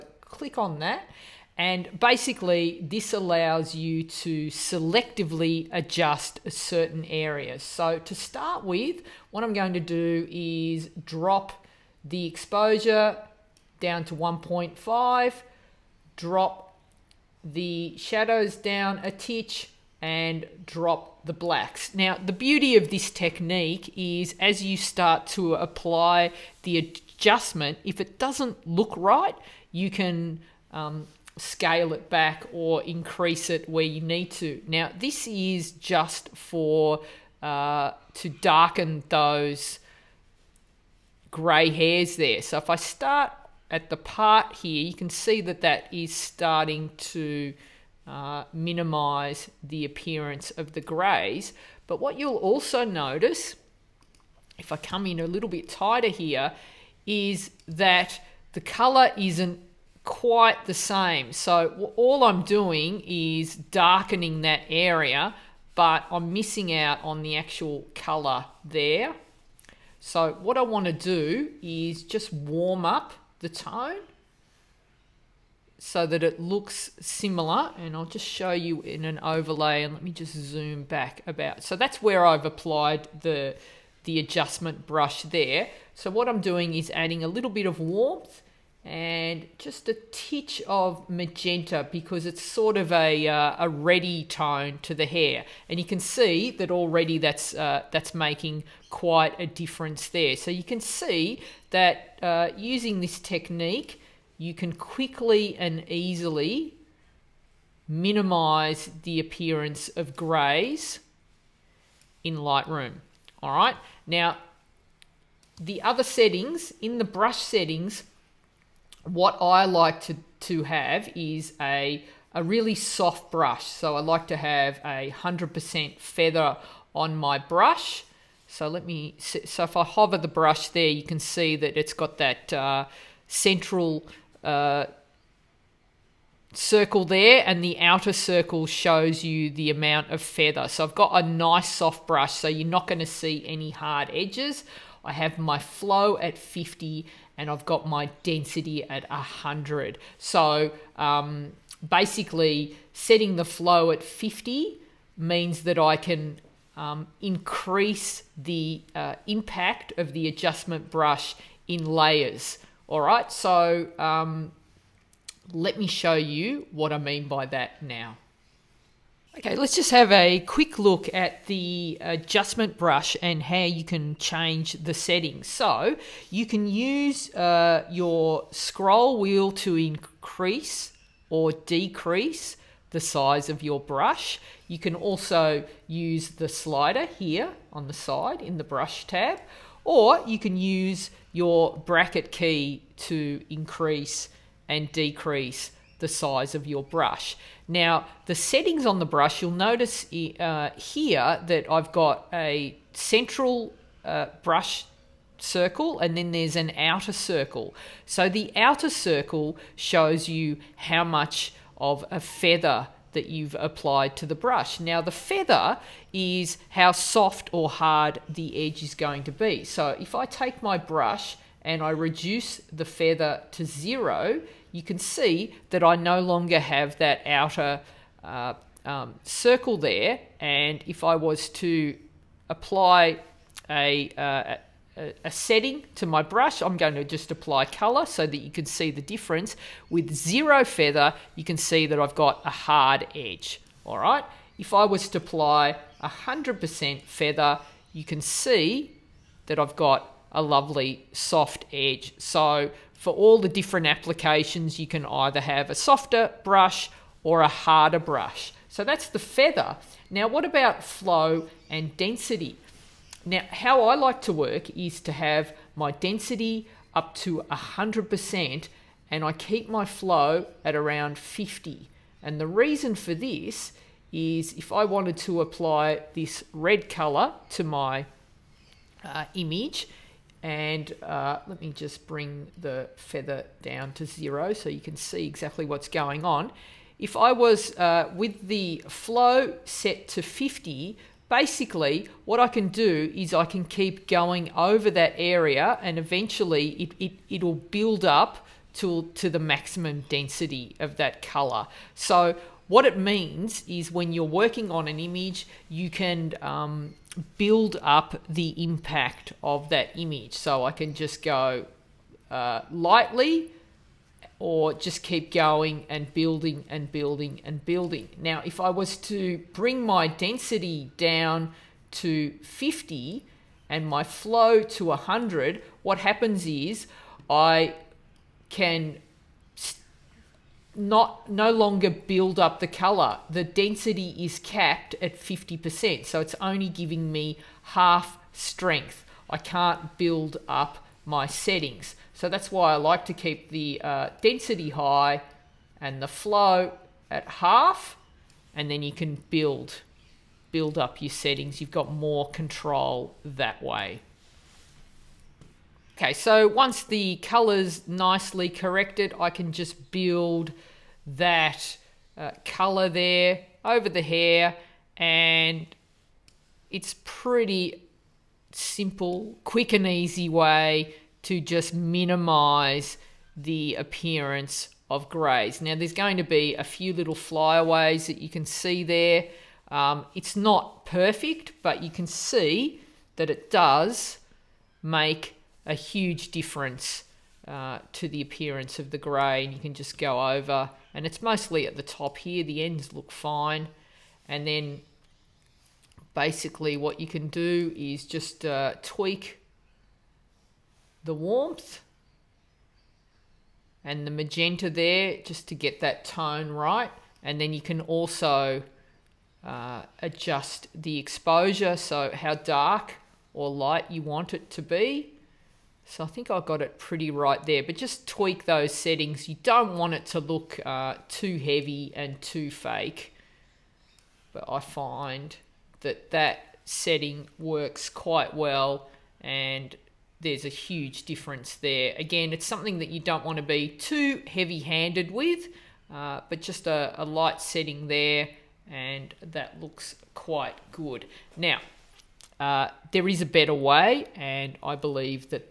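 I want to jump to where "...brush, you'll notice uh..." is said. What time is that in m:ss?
3:19.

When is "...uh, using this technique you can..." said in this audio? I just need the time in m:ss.
1:42.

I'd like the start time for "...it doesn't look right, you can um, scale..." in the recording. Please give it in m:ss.
0:27.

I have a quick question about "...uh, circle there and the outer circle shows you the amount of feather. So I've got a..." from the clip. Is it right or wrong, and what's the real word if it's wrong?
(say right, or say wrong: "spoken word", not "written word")
right.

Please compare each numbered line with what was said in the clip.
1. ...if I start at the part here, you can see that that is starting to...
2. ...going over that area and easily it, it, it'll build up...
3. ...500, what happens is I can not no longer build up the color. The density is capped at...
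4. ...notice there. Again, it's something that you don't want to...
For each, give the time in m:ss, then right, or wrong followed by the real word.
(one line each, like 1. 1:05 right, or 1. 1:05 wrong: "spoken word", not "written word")
1. 0:42 right
2. 4:54 wrong: "eventually", not "easily"
3. 5:24 wrong: "100", not "500"
4. 7:11 wrong: "difference", not "notice".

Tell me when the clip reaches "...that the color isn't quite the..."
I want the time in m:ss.
0:57.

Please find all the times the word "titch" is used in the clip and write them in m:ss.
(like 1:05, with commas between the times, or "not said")
0:19, 1:30.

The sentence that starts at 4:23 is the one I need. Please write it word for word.
Now, how I like to work is to have my density up to 100% and I keep my flow at around 50.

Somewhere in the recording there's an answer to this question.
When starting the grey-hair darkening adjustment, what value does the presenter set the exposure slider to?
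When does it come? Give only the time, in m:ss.
0:14.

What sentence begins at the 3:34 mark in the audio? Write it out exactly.
Now the feather is how soft or hard the edge is going to be.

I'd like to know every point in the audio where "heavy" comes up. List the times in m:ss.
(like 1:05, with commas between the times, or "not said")
7:01, 7:14.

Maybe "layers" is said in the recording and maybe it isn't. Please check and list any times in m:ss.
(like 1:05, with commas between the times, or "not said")
2:41.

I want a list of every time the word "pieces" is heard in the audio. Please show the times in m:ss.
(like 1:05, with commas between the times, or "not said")
not said.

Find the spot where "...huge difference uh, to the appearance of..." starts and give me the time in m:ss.
6:25.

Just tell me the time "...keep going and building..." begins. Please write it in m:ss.
5:15.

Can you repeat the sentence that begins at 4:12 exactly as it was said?
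So for all the different applications, you can either have a softer brush or a harder brush.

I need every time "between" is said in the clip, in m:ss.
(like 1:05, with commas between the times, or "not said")
not said.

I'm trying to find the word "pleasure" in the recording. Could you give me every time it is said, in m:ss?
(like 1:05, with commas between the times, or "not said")
not said.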